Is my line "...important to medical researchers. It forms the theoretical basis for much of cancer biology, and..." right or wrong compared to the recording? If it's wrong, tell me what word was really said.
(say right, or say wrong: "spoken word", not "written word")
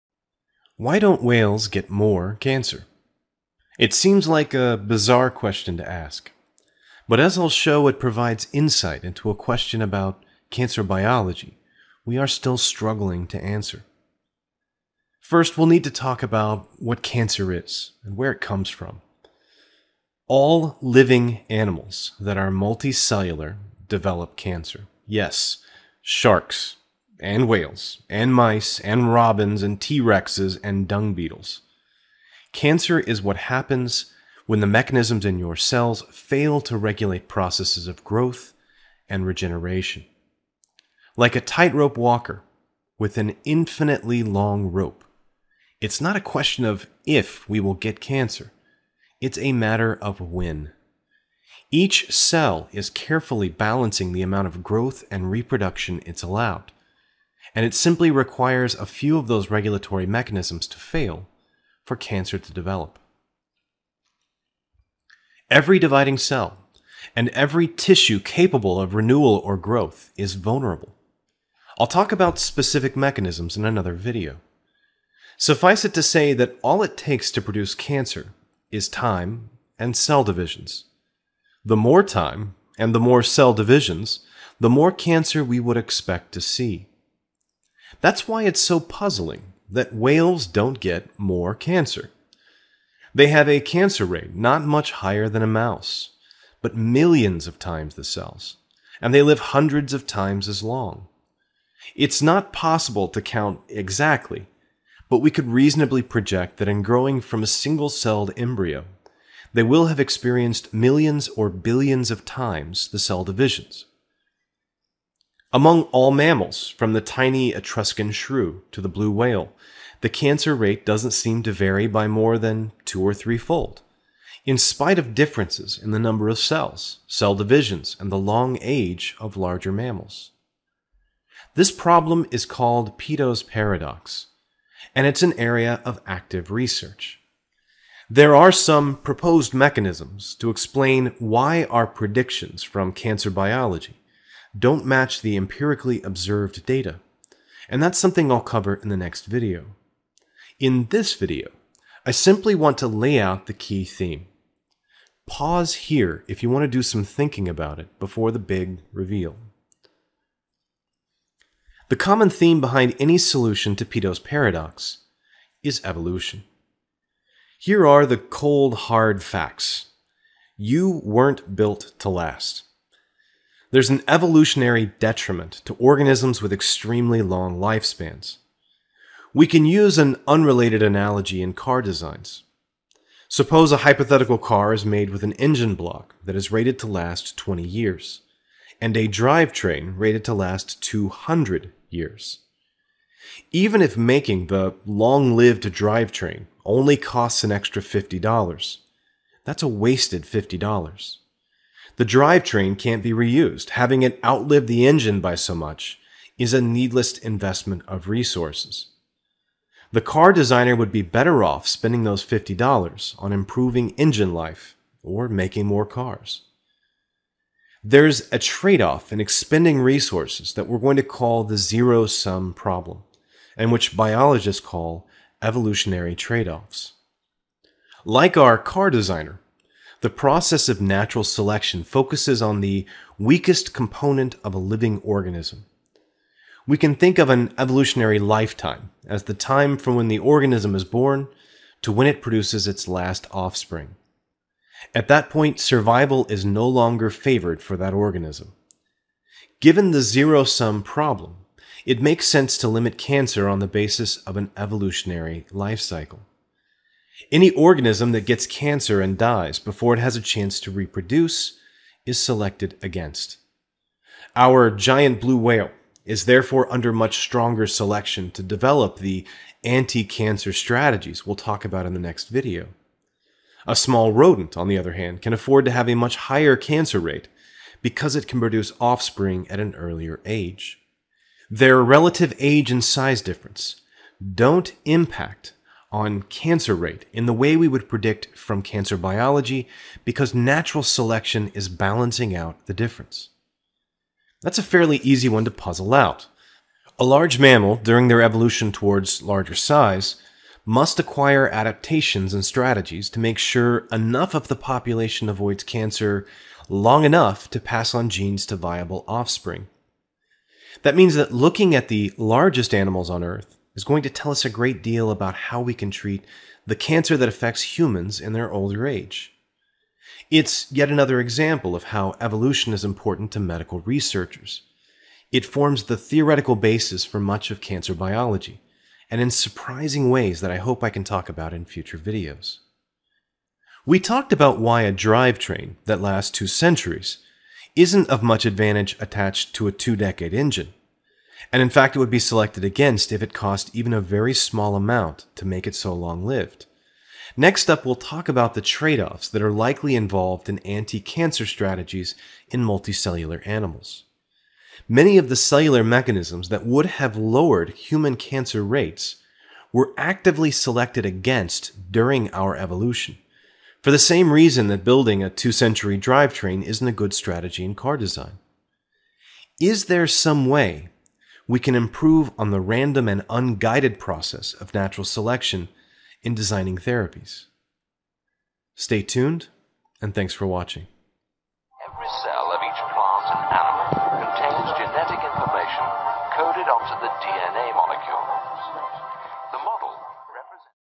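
right.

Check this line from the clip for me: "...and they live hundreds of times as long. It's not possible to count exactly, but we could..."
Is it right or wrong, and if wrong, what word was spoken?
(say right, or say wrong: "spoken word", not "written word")
right.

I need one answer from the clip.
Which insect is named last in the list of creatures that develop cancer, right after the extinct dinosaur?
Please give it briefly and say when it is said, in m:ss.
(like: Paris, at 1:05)
Dung beetles, at 0:30.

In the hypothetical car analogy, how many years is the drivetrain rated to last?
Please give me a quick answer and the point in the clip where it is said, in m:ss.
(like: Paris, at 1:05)
200 years, at 3:10.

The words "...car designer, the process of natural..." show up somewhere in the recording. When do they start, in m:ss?
3:48.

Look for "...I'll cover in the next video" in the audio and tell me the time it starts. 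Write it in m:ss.
2:28.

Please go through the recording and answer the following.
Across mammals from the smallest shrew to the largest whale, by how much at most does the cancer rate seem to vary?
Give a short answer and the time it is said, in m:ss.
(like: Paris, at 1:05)
Two or threefold, at 2:02.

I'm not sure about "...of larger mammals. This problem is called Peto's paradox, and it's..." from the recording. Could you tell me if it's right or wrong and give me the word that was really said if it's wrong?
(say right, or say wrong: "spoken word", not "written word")
right.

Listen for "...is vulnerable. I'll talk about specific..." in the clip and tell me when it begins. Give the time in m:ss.
1:10.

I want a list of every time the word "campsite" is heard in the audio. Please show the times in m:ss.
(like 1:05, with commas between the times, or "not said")
not said.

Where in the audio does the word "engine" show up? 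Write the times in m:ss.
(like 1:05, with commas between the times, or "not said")
3:05, 3:24, 3:33, 5:40.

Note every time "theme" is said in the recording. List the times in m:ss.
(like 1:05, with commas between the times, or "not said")
2:33, 2:42.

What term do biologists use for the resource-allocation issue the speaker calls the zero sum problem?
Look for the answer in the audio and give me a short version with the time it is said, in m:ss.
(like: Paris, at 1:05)
Evolutionary trade offs, at 3:45.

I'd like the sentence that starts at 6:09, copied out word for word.
Is there some way we can improve on the random and unguided process of natural selection in designing therapies.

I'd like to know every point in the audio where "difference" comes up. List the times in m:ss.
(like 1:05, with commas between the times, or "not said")
2:05, 4:43, 4:52.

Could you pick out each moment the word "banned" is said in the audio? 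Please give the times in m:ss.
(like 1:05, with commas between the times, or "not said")
not said.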